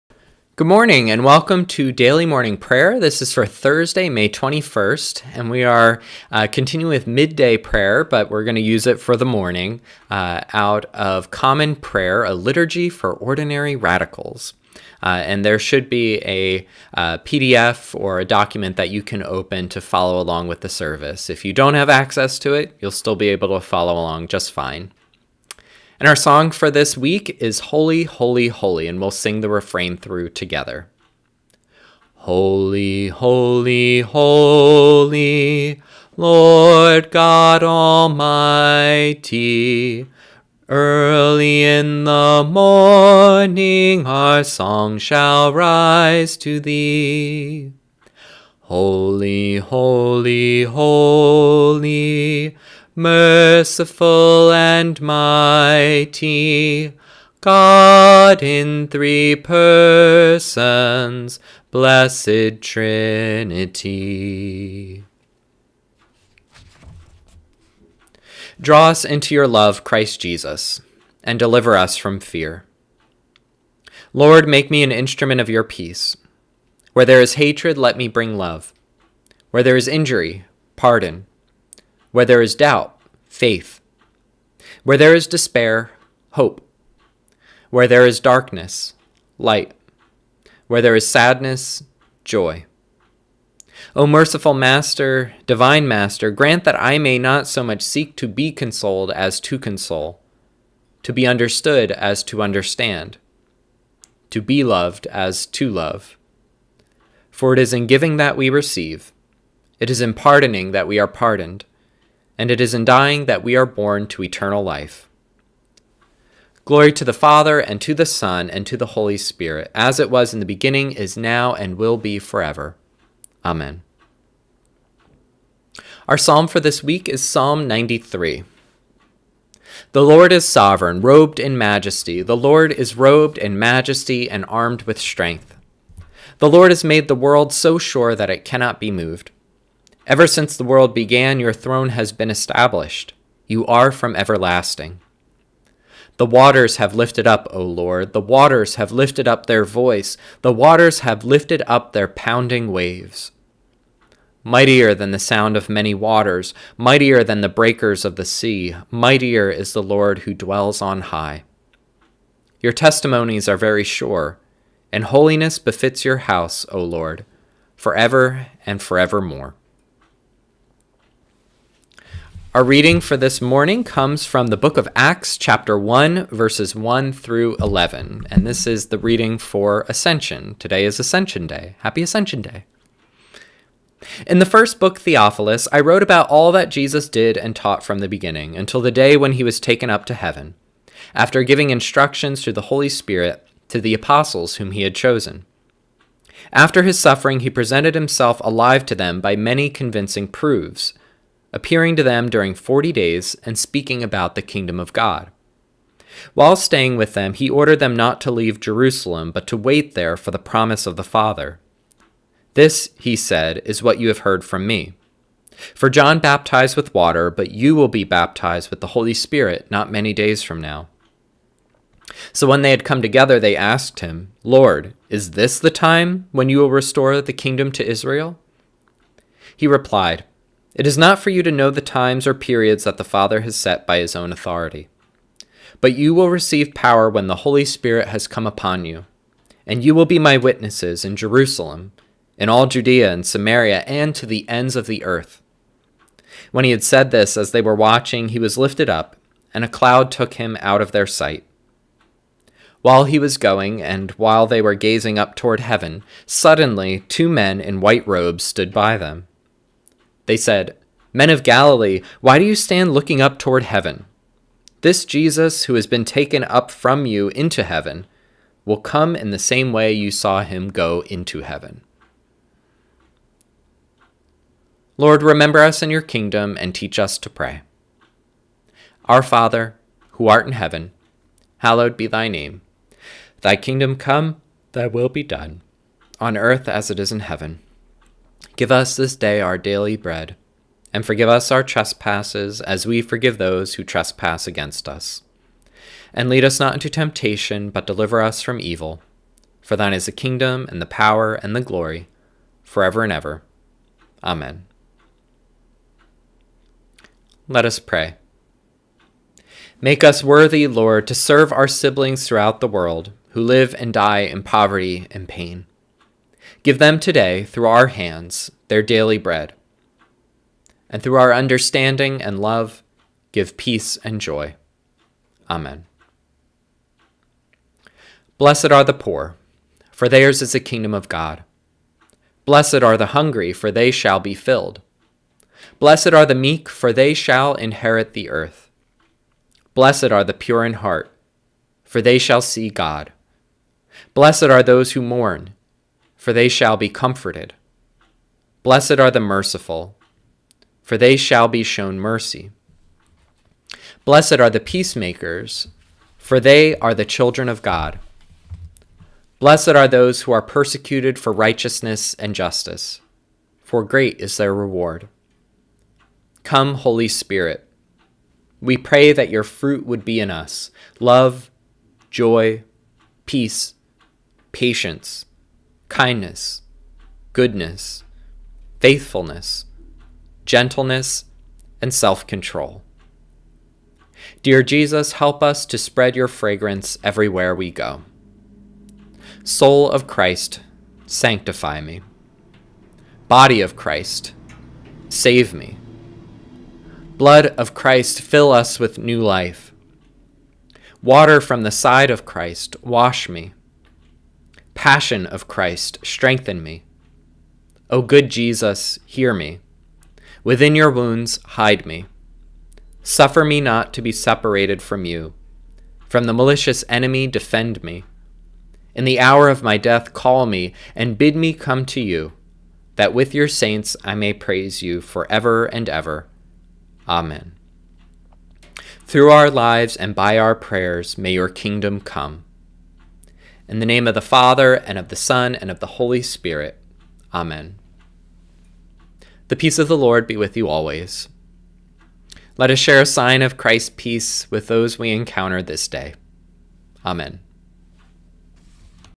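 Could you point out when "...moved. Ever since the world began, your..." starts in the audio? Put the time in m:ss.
2:18.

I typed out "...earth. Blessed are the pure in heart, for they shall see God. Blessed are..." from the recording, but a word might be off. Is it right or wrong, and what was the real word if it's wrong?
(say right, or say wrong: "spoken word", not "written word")
right.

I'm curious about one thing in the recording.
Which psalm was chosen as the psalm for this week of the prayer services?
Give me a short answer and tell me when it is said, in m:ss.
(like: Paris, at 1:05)
Psalm 93, at 2:07.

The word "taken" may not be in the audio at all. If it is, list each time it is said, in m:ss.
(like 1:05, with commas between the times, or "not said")
3:09, 4:26.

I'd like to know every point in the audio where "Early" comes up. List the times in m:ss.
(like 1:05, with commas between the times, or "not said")
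0:40.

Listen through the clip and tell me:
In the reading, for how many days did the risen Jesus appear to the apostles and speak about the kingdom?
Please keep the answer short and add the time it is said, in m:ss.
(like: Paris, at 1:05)
40, at 3:22.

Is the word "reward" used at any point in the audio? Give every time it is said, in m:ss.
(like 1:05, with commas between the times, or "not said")
6:04.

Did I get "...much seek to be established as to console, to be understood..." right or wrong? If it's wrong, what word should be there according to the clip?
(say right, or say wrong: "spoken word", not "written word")
wrong: "consoled", not "established".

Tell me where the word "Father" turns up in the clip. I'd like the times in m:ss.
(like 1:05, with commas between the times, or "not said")
1:57, 3:31, 3:53, 4:39, 7:14.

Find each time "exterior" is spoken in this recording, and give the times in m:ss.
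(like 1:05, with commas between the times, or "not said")
not said.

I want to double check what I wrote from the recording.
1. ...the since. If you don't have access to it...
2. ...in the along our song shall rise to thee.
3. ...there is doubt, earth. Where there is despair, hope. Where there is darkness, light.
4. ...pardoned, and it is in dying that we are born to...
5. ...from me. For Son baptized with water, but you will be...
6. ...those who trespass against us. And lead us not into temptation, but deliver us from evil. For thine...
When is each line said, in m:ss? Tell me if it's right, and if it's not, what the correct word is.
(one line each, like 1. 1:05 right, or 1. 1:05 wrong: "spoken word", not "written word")
1. 0:20 wrong: "service", not "since"
2. 0:41 wrong: "morning", not "along"
3. 1:22 wrong: "faith", not "earth"
4. 1:51 right
5. 3:34 wrong: "John", not "Son"
6. 4:53 right.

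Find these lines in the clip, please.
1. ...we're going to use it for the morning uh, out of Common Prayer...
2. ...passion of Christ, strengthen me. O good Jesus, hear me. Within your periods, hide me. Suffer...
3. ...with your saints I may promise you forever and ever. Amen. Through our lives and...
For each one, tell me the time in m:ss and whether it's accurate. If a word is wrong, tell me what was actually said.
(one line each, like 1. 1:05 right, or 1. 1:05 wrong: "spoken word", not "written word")
1. 0:08 right
2. 6:44 wrong: "wounds", not "periods"
3. 7:03 wrong: "praise", not "promise".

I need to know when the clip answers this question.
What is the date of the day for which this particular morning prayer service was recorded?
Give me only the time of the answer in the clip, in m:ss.
0:03.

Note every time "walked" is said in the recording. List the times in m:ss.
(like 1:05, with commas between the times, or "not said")
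not said.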